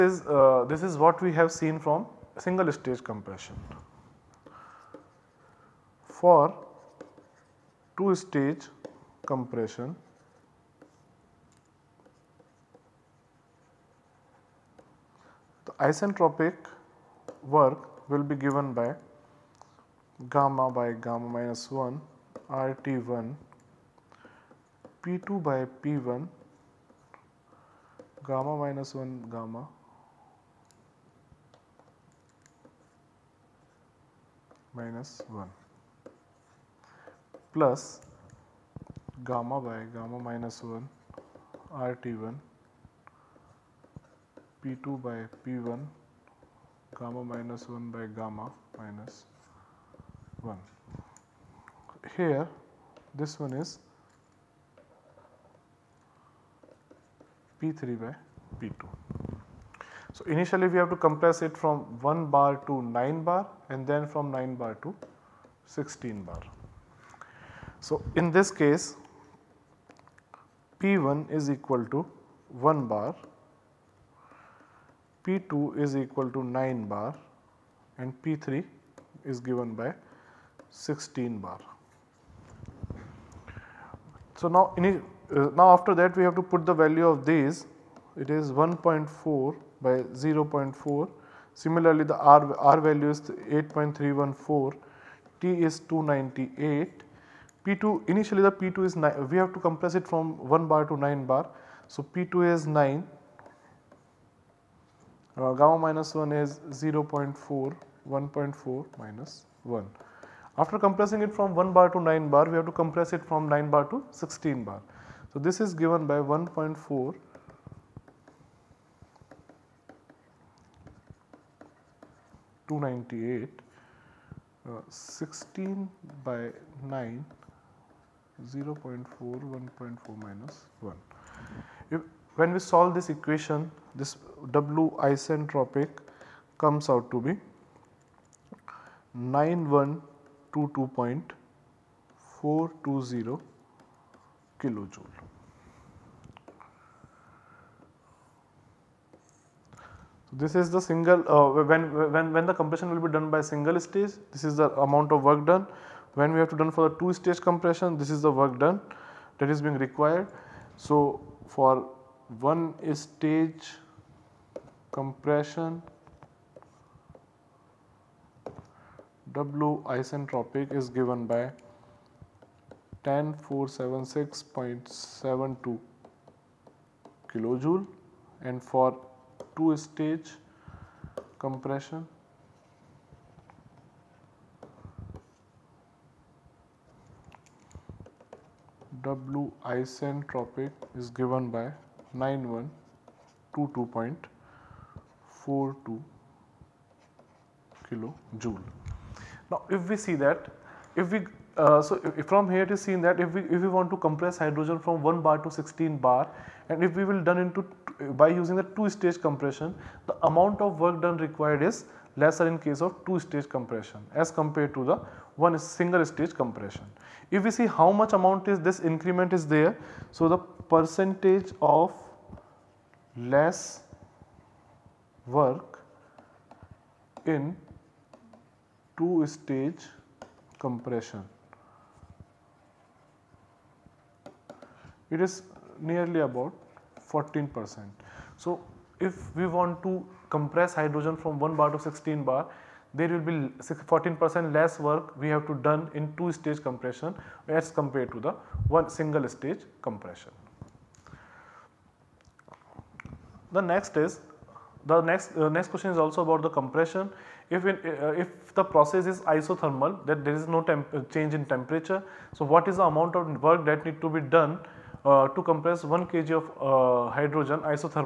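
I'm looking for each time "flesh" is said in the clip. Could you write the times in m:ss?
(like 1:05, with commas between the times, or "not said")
not said.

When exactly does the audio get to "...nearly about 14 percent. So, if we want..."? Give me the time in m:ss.
3:55.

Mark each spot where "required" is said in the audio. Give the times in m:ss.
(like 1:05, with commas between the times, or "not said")
2:39, 3:31.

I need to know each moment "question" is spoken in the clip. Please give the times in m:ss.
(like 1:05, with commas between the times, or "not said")
4:15.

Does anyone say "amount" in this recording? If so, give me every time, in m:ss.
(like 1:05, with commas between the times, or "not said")
2:34, 3:30, 3:38, 4:22.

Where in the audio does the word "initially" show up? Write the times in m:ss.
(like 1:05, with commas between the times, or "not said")
1:00, 1:38.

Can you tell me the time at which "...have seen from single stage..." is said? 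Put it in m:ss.
0:01.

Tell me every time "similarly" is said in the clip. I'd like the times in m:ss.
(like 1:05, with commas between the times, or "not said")
1:31.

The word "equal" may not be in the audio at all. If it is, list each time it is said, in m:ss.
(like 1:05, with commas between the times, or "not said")
1:11, 1:15.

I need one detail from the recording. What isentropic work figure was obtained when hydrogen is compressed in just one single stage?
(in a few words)
10476.72 kilojoule.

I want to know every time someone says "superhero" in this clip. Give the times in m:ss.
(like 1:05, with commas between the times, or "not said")
not said.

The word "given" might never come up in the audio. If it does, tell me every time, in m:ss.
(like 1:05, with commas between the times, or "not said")
0:18, 1:19, 2:51, 3:11.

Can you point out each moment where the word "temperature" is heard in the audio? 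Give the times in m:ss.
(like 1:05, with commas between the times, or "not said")
4:21.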